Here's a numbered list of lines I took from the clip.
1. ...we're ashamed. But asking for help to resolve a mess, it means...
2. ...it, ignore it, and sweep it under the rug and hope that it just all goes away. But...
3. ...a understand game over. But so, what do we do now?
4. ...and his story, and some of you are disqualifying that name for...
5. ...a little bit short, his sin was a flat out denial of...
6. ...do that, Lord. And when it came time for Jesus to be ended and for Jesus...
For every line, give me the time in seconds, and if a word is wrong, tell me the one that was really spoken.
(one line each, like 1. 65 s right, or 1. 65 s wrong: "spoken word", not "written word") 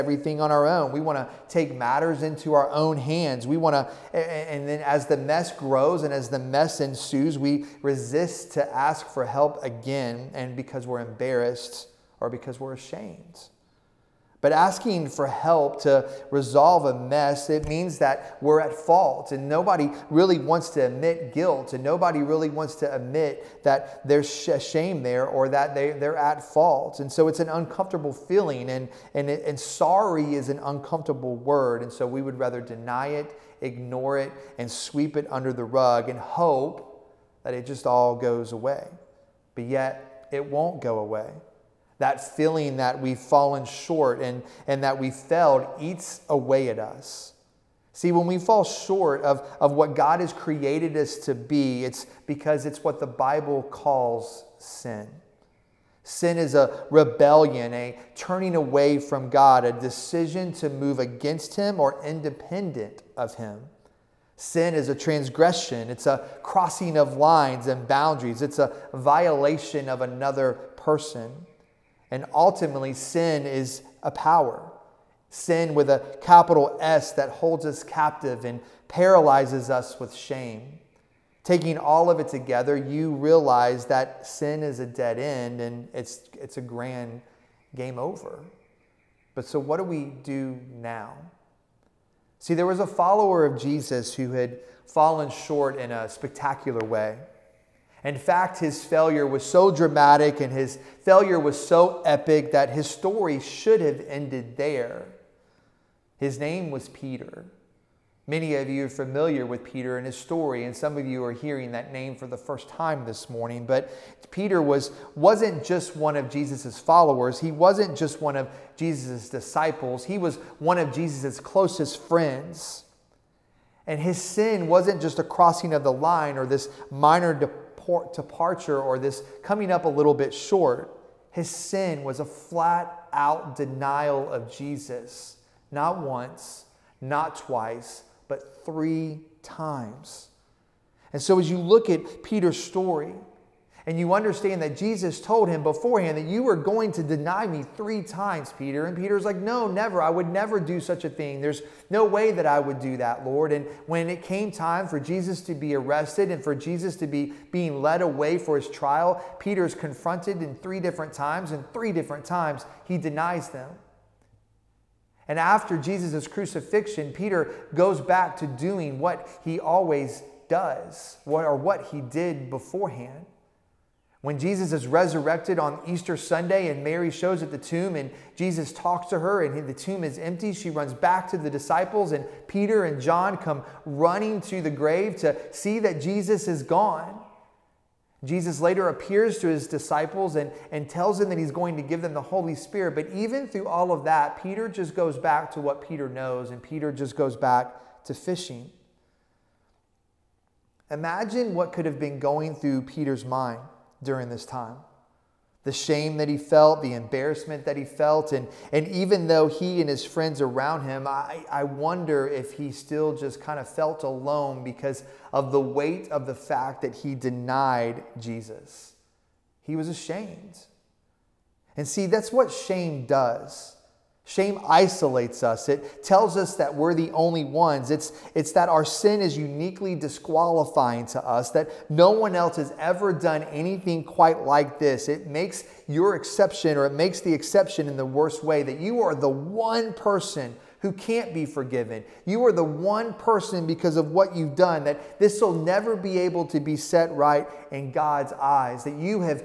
1. 12 s right
2. 33 s right
3. 86 s wrong: "grand", not "understand"
4. 109 s wrong: "hearing", not "disqualifying"
5. 129 s right
6. 152 s wrong: "arrested", not "ended".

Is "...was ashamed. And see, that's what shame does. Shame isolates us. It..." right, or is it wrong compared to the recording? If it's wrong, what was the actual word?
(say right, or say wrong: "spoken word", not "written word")
right.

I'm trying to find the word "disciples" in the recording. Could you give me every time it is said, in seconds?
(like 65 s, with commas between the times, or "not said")
119 s, 181 s, 189 s.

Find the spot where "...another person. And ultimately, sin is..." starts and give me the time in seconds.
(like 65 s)
70 s.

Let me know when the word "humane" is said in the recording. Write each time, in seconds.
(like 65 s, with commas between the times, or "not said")
not said.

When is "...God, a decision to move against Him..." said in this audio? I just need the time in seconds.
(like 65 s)
59 s.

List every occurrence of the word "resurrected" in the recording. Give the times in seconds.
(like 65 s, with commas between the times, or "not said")
174 s.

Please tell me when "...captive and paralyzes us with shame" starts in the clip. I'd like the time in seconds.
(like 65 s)
77 s.